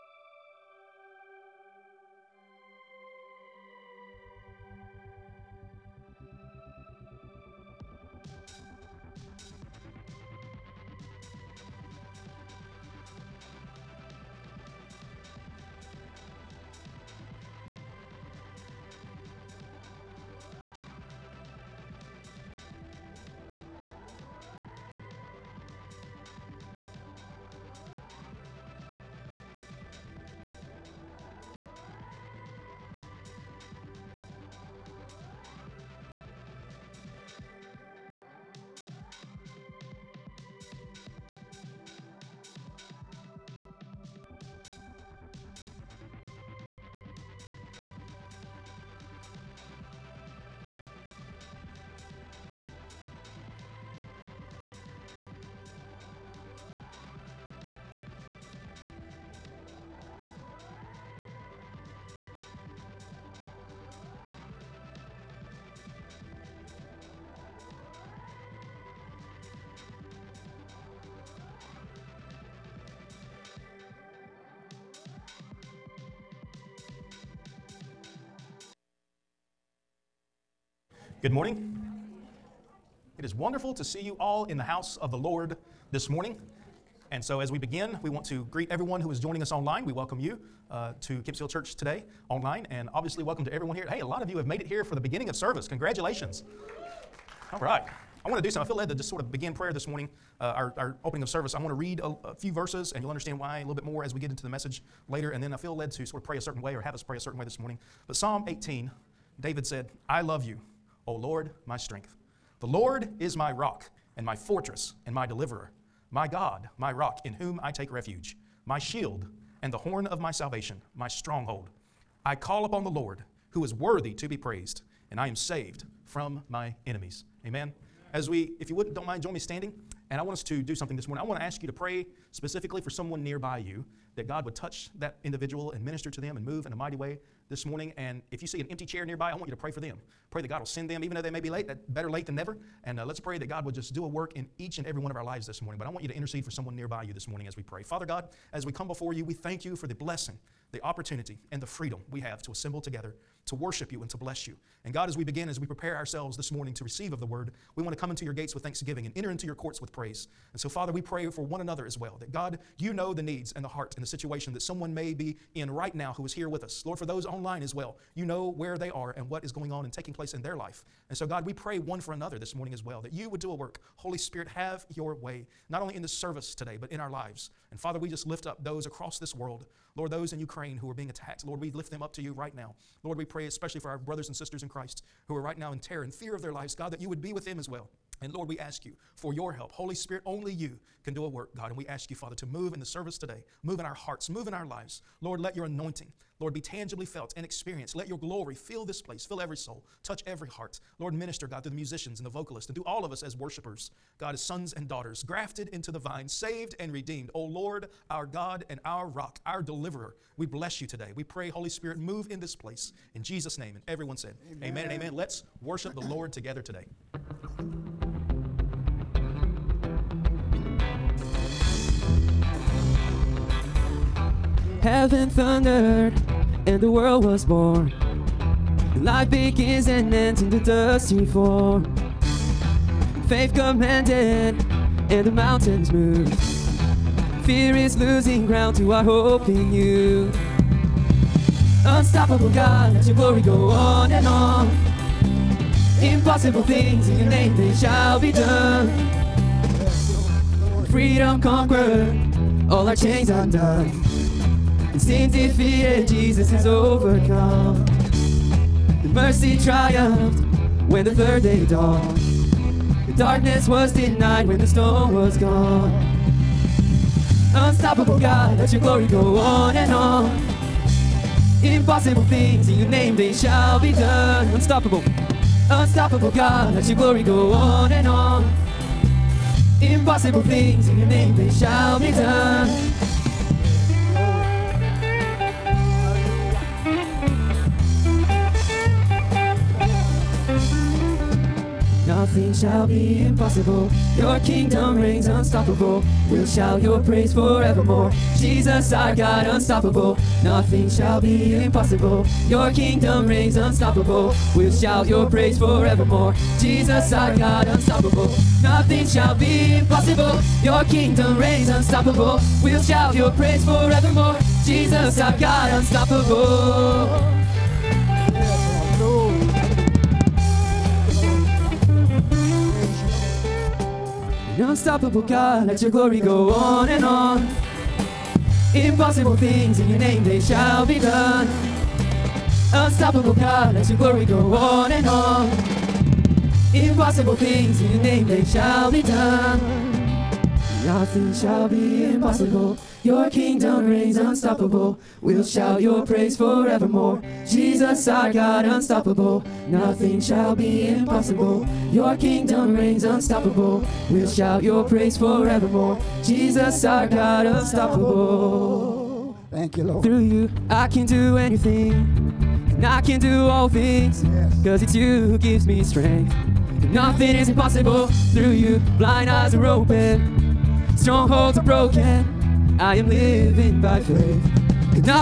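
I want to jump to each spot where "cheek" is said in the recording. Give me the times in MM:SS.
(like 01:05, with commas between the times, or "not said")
not said.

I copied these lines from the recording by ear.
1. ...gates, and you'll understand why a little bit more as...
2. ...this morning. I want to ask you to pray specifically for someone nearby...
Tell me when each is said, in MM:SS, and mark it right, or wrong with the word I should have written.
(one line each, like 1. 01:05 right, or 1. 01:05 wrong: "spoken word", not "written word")
1. 01:42 wrong: "verses", not "gates"
2. 02:10 right.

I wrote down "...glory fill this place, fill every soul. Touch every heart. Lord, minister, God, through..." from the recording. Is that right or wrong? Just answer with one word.
right.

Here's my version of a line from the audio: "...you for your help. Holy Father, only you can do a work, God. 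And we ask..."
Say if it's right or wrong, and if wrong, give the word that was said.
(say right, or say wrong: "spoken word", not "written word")
wrong: "Spirit", not "Father".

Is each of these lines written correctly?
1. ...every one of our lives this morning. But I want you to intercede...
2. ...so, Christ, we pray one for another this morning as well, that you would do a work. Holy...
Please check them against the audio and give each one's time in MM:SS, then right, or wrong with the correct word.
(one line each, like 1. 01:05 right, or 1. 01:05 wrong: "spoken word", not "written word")
1. 02:24 right
2. 02:51 wrong: "God", not "Christ".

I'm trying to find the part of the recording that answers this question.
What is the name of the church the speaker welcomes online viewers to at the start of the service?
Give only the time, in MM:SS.
01:31.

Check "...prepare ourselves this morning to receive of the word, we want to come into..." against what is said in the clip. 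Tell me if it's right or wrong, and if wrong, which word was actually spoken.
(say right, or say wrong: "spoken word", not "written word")
right.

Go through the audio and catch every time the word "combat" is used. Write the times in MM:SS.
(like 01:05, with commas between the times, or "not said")
not said.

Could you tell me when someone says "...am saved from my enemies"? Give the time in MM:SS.
02:05.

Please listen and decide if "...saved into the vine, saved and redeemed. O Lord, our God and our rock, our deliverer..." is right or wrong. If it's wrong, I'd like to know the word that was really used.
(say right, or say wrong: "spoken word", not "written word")
wrong: "grafted", not "saved".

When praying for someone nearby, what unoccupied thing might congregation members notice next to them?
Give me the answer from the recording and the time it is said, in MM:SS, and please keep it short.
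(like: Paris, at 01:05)
an empty chair, at 02:18.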